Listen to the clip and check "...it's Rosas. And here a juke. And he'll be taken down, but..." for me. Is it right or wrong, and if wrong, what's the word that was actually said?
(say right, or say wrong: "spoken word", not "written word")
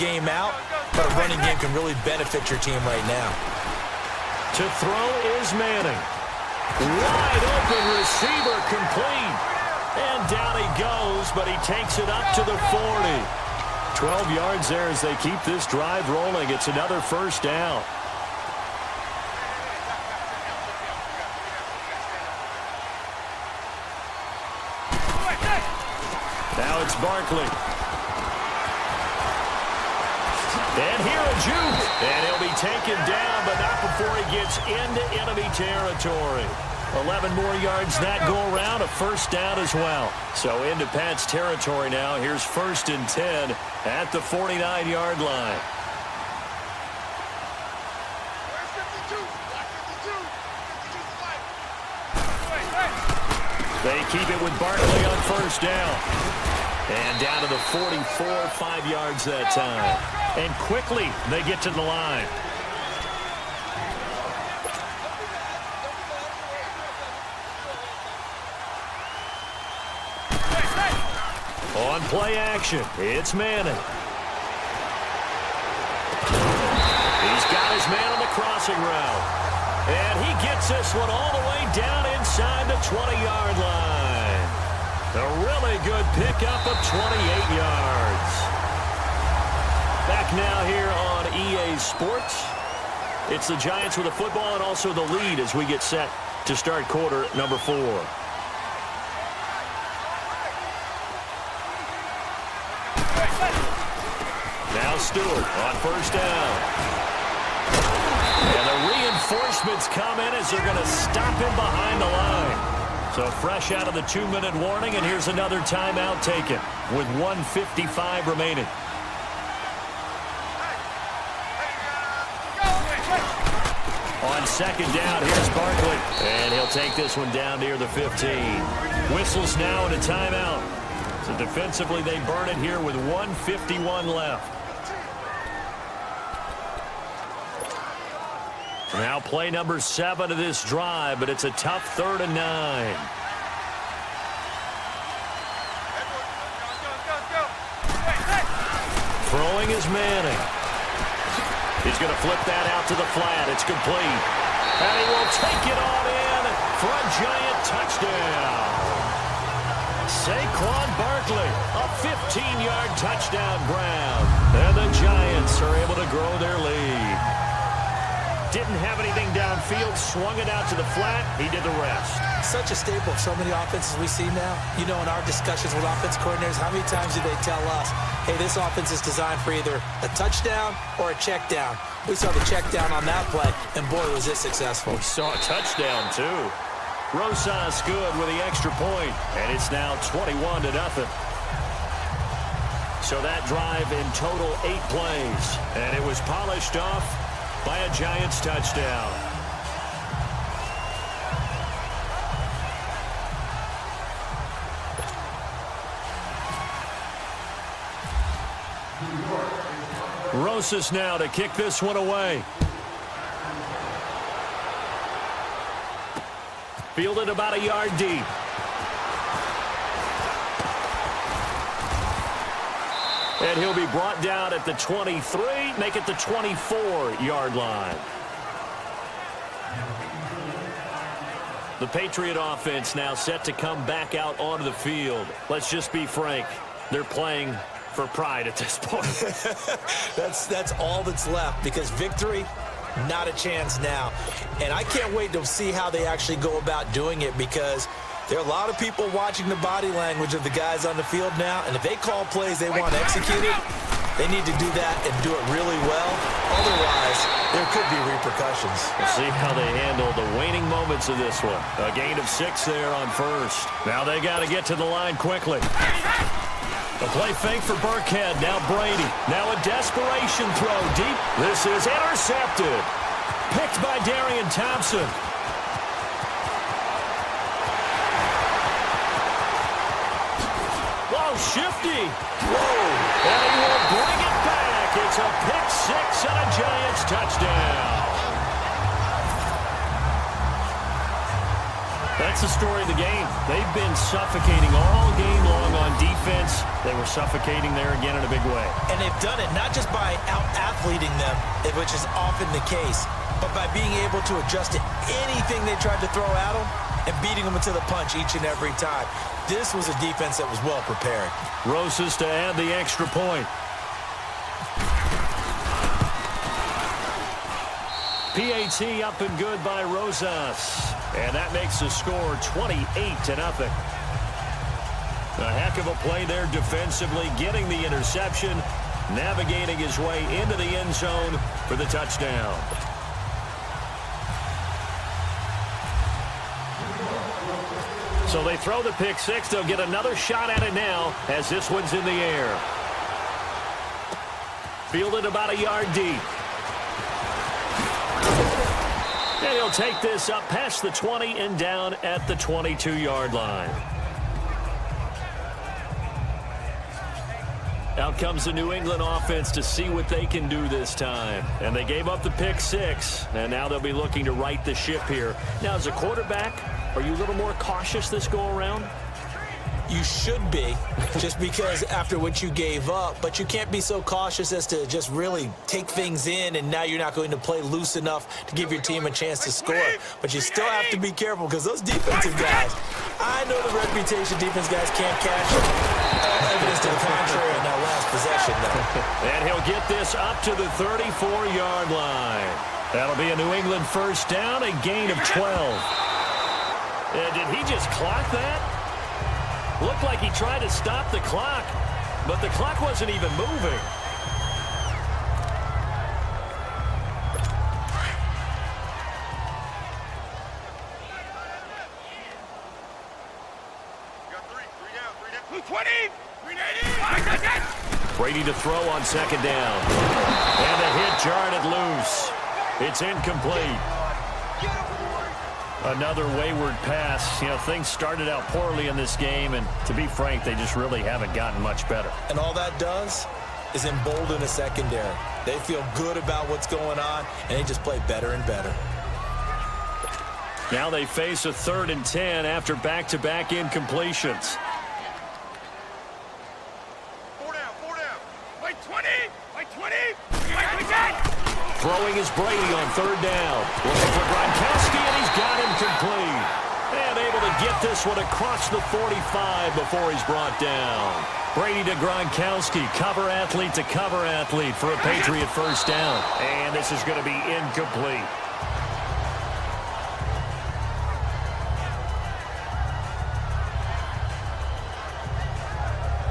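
wrong: "Barkley", not "Rosas".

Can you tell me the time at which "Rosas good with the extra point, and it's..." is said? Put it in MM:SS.
03:07.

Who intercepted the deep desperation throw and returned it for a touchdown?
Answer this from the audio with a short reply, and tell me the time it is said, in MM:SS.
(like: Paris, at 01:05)
Darian Thompson, at 04:34.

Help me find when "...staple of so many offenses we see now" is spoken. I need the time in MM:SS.
02:52.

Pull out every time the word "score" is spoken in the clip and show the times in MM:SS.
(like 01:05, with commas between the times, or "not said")
05:21, 06:19.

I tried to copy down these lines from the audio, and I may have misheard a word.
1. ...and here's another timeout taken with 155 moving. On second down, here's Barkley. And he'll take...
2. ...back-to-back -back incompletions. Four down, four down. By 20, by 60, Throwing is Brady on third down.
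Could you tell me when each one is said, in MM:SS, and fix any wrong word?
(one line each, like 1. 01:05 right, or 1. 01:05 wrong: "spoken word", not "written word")
1. 01:54 wrong: "remaining", not "moving"
2. 07:22 wrong: "20", not "60".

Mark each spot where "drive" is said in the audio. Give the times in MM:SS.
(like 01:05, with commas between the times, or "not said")
00:15, 02:20, 03:13.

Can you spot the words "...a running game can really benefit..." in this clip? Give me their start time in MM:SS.
00:01.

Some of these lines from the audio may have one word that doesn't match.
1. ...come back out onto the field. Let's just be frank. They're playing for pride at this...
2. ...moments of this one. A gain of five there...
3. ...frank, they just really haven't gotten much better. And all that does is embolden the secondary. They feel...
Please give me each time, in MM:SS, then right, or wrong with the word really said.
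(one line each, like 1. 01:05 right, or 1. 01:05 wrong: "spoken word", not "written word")
1. 03:53 right
2. 04:20 wrong: "six", not "five"
3. 07:10 right.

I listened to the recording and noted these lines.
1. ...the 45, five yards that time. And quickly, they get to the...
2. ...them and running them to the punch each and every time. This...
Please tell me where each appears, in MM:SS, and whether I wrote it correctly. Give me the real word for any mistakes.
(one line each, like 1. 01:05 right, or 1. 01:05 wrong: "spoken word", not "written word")
1. 00:57 wrong: "44", not "45"
2. 05:06 wrong: "beating", not "running".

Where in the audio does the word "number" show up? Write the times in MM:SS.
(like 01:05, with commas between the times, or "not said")
01:37, 02:19.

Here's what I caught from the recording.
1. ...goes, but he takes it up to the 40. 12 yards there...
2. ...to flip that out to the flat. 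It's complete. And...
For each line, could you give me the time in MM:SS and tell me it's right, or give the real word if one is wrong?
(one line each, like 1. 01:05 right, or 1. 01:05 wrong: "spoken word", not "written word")
1. 00:10 right
2. 02:32 right.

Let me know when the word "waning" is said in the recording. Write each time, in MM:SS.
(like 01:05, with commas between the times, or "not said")
04:20.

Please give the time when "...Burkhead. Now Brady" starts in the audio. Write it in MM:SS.
04:27.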